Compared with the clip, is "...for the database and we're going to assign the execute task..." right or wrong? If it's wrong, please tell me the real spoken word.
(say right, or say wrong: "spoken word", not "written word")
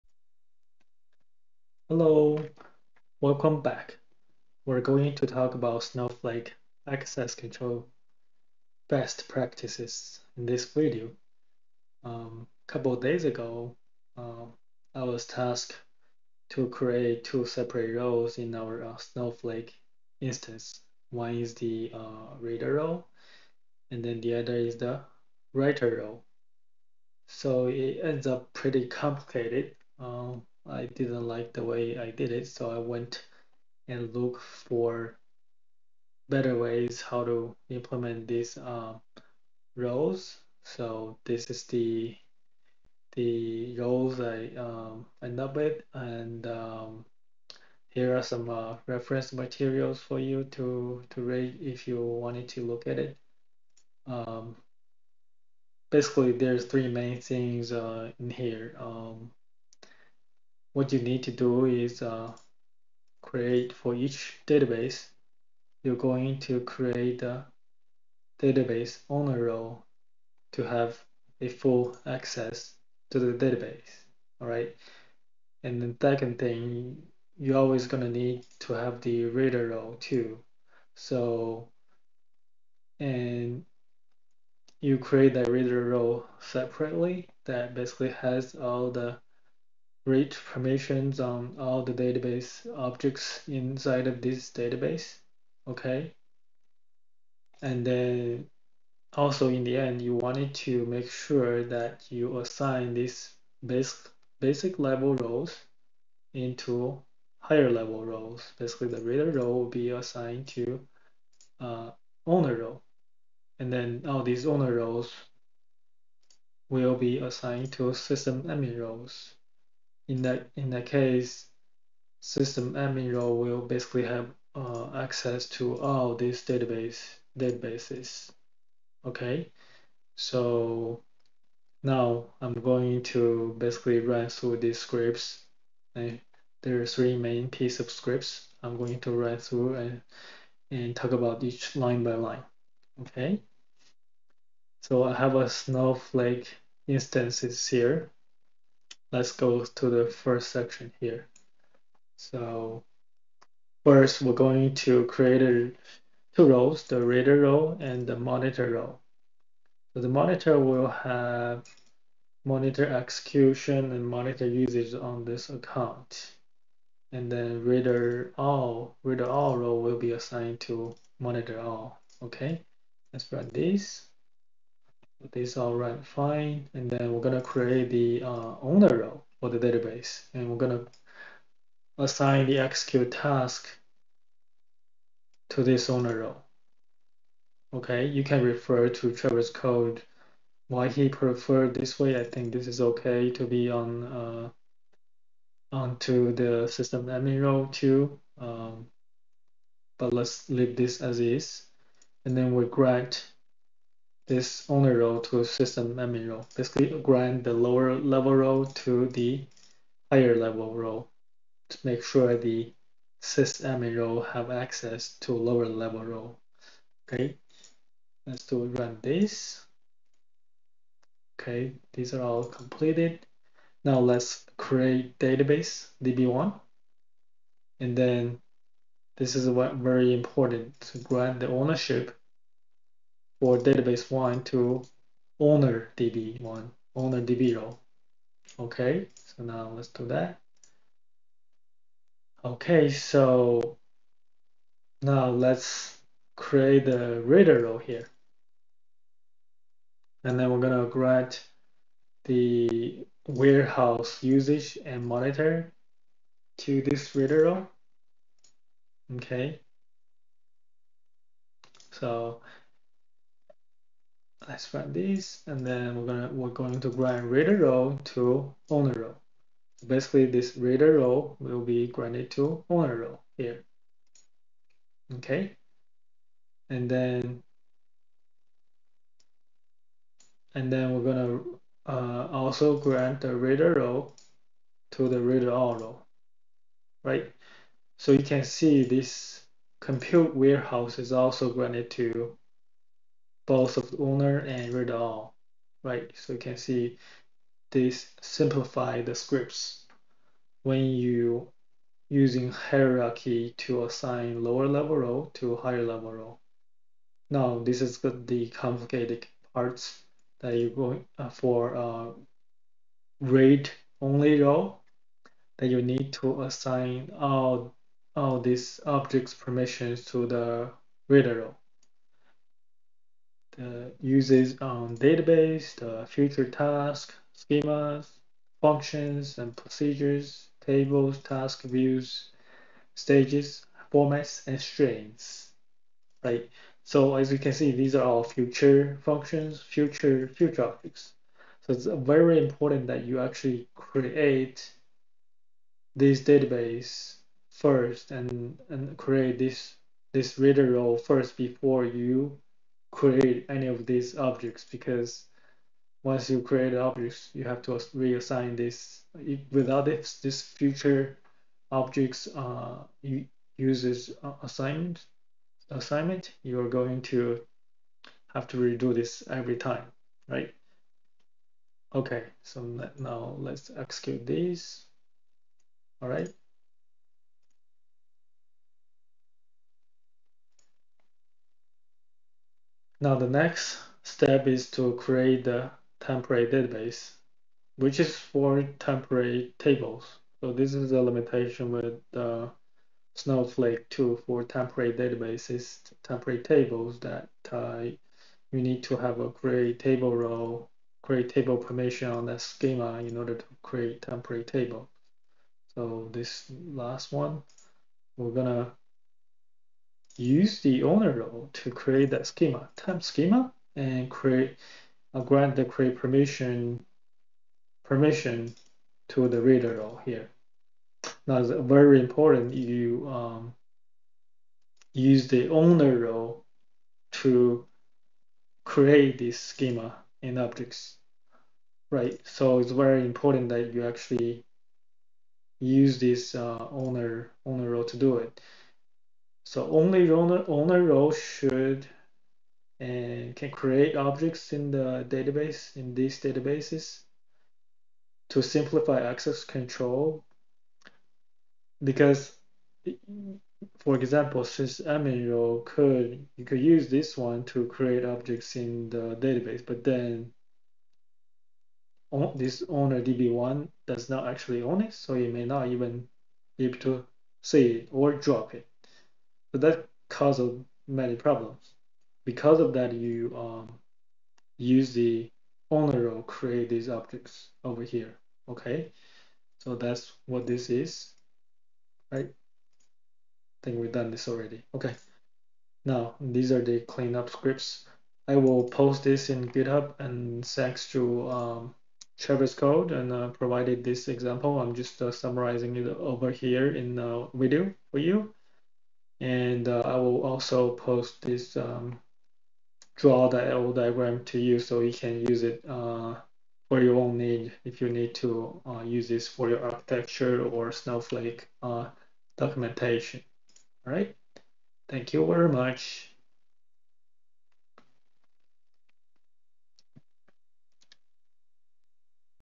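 right.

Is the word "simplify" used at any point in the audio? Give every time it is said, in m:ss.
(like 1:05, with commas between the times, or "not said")
4:58, 7:28.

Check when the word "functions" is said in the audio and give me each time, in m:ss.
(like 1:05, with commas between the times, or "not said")
5:28, 5:39.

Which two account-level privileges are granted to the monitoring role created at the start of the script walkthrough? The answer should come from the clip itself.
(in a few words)
monitor execution and monitor usage.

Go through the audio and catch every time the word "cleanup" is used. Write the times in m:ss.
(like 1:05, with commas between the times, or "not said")
8:06.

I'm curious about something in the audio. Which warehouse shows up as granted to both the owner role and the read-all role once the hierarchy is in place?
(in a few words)
compute warehouse.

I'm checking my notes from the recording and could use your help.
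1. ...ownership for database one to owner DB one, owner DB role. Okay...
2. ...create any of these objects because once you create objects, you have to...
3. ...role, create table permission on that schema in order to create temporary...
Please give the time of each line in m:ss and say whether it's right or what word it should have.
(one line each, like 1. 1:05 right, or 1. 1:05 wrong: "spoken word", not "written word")
1. 3:51 right
2. 5:52 right
3. 6:40 right.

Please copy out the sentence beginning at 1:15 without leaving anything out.
And the second thing, you're always gonna need to have the reader role too.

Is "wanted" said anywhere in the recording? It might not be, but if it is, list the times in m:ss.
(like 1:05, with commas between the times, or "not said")
0:52, 1:40.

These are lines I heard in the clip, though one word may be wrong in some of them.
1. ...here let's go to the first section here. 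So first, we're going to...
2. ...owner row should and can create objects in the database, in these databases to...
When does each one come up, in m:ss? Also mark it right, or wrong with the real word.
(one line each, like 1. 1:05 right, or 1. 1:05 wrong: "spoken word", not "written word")
1. 2:27 right
2. 7:20 right.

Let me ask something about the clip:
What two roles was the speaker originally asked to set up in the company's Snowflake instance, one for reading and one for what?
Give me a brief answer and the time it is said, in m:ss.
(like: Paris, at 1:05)
writer role, at 0:25.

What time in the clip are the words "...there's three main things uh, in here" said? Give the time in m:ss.
0:56.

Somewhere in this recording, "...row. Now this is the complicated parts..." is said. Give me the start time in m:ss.
5:06.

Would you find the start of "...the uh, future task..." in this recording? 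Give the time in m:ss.
5:25.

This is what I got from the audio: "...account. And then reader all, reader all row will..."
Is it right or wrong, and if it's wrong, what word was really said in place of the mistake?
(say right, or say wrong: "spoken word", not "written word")
right.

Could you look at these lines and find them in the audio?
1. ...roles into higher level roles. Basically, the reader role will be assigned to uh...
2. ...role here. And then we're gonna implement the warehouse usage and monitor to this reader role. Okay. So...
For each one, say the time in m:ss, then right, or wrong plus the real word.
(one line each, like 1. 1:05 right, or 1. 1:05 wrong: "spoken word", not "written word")
1. 1:45 right
2. 4:07 wrong: "grant", not "implement".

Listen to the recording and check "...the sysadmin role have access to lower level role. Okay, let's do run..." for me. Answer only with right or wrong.
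right.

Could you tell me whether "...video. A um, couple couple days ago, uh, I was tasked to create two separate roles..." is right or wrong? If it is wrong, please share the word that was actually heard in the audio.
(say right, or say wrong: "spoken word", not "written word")
right.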